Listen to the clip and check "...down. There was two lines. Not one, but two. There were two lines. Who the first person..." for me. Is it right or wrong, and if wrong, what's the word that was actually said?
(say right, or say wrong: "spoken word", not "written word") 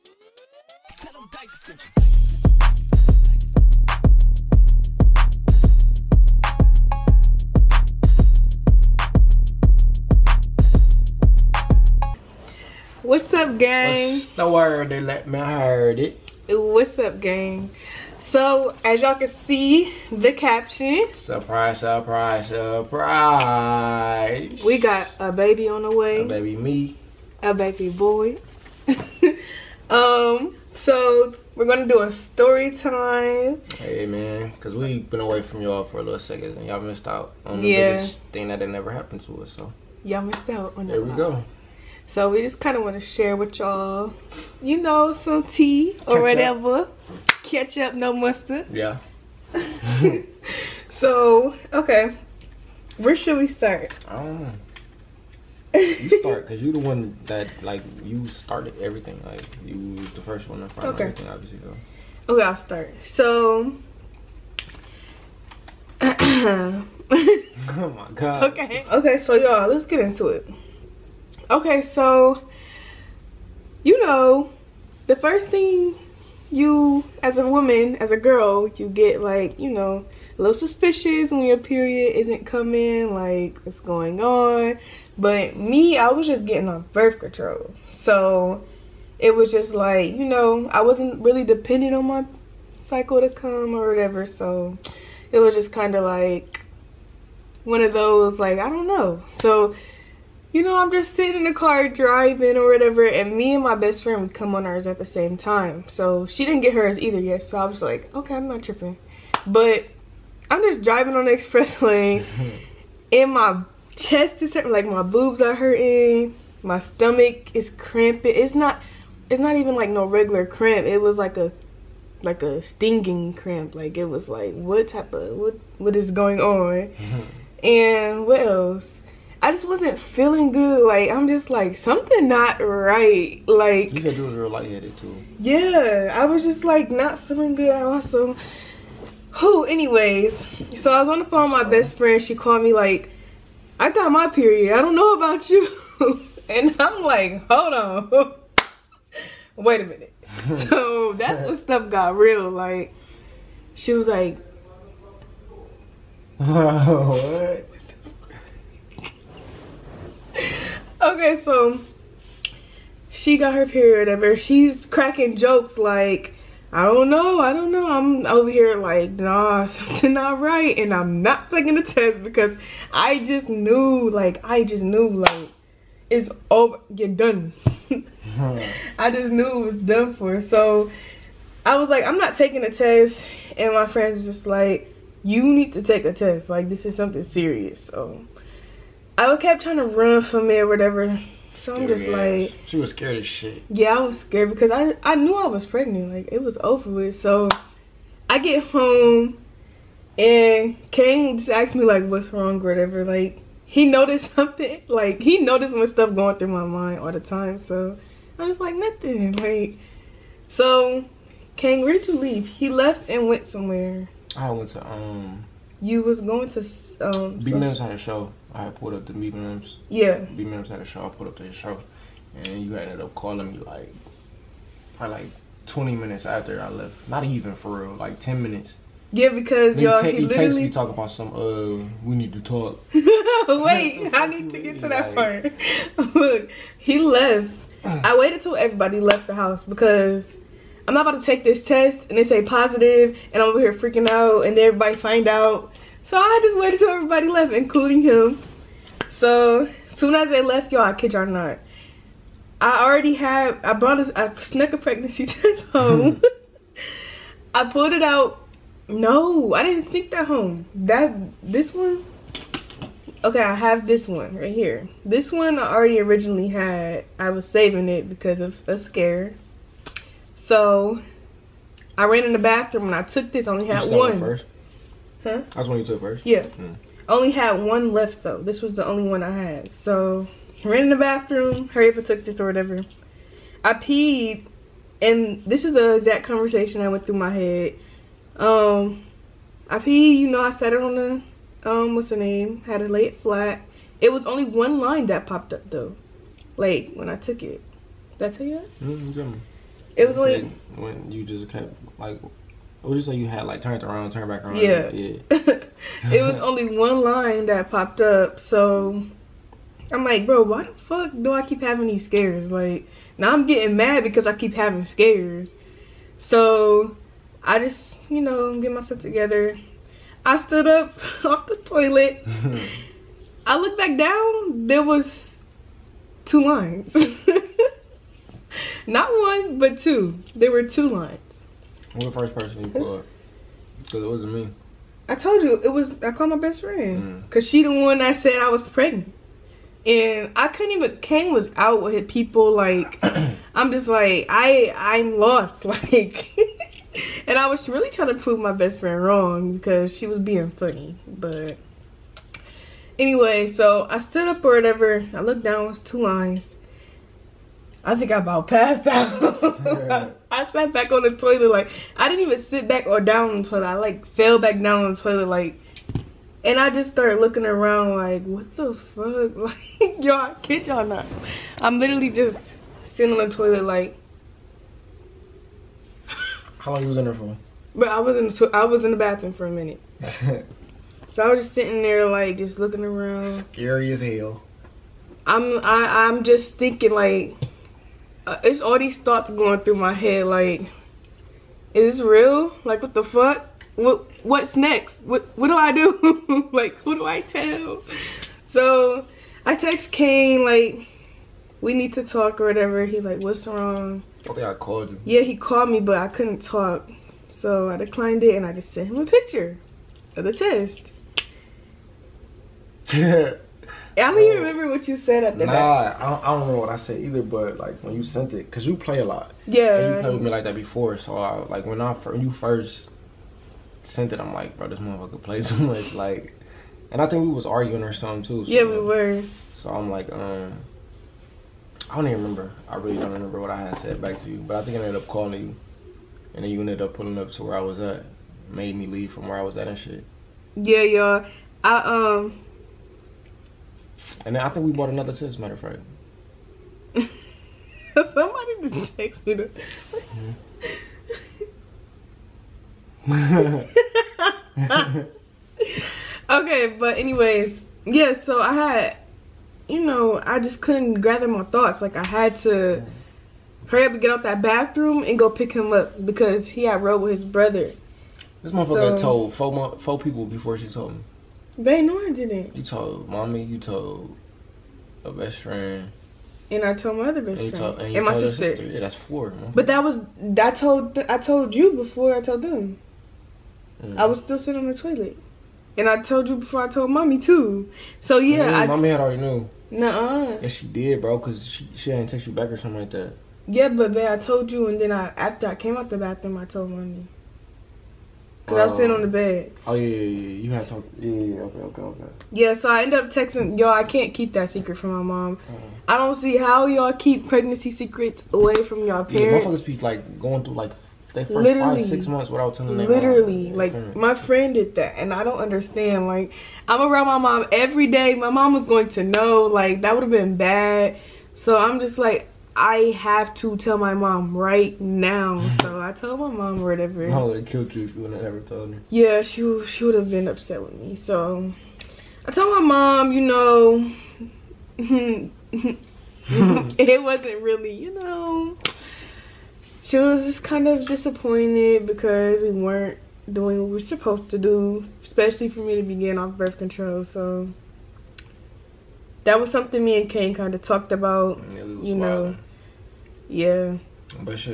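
right.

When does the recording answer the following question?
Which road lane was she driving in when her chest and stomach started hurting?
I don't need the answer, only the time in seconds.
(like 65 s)
111 s.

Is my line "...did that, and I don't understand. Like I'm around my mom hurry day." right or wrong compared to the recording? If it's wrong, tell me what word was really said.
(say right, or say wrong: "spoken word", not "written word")
wrong: "every", not "hurry".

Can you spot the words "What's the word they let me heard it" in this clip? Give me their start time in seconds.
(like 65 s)
14 s.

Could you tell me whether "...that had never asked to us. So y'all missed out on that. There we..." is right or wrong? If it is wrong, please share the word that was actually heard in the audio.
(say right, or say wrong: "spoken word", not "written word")
wrong: "happened", not "asked".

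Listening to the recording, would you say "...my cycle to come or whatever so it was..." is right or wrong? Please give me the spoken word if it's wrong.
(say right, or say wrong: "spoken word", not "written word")
right.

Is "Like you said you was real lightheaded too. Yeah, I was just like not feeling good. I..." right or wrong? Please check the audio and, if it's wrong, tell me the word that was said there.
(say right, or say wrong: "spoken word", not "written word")
right.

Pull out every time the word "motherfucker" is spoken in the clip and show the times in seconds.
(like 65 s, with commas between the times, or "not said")
424 s, 468 s, 509 s.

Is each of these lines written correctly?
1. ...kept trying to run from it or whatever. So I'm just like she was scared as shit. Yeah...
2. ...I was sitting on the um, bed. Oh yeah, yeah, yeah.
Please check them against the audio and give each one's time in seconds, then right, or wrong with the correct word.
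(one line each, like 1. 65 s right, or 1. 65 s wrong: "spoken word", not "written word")
1. 189 s right
2. 498 s right.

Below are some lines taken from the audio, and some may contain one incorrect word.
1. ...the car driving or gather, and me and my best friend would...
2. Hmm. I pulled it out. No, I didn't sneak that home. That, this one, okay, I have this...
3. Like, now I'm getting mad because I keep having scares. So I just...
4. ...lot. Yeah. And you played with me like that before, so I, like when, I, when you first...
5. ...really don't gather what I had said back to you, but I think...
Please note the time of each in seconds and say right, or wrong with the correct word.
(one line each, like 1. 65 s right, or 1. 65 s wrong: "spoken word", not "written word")
1. 101 s wrong: "whatever", not "gather"
2. 256 s right
3. 312 s right
4. 419 s right
5. 432 s wrong: "remember", not "gather".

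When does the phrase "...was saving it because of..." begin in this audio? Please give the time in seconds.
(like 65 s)
267 s.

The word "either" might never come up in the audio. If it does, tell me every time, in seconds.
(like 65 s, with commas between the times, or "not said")
106 s, 417 s.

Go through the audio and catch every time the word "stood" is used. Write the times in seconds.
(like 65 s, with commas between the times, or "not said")
320 s, 353 s.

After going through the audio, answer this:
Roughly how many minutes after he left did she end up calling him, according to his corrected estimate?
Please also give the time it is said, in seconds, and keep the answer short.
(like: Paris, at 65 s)
10, at 228 s.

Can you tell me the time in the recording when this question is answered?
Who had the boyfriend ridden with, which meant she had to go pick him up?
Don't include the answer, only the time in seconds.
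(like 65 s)
467 s.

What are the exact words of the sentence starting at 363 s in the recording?
I like fell back down on the toilet like and I just started looking around like what the fuck?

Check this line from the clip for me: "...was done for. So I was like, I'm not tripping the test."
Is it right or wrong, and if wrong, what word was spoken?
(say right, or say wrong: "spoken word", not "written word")
wrong: "taking", not "tripping".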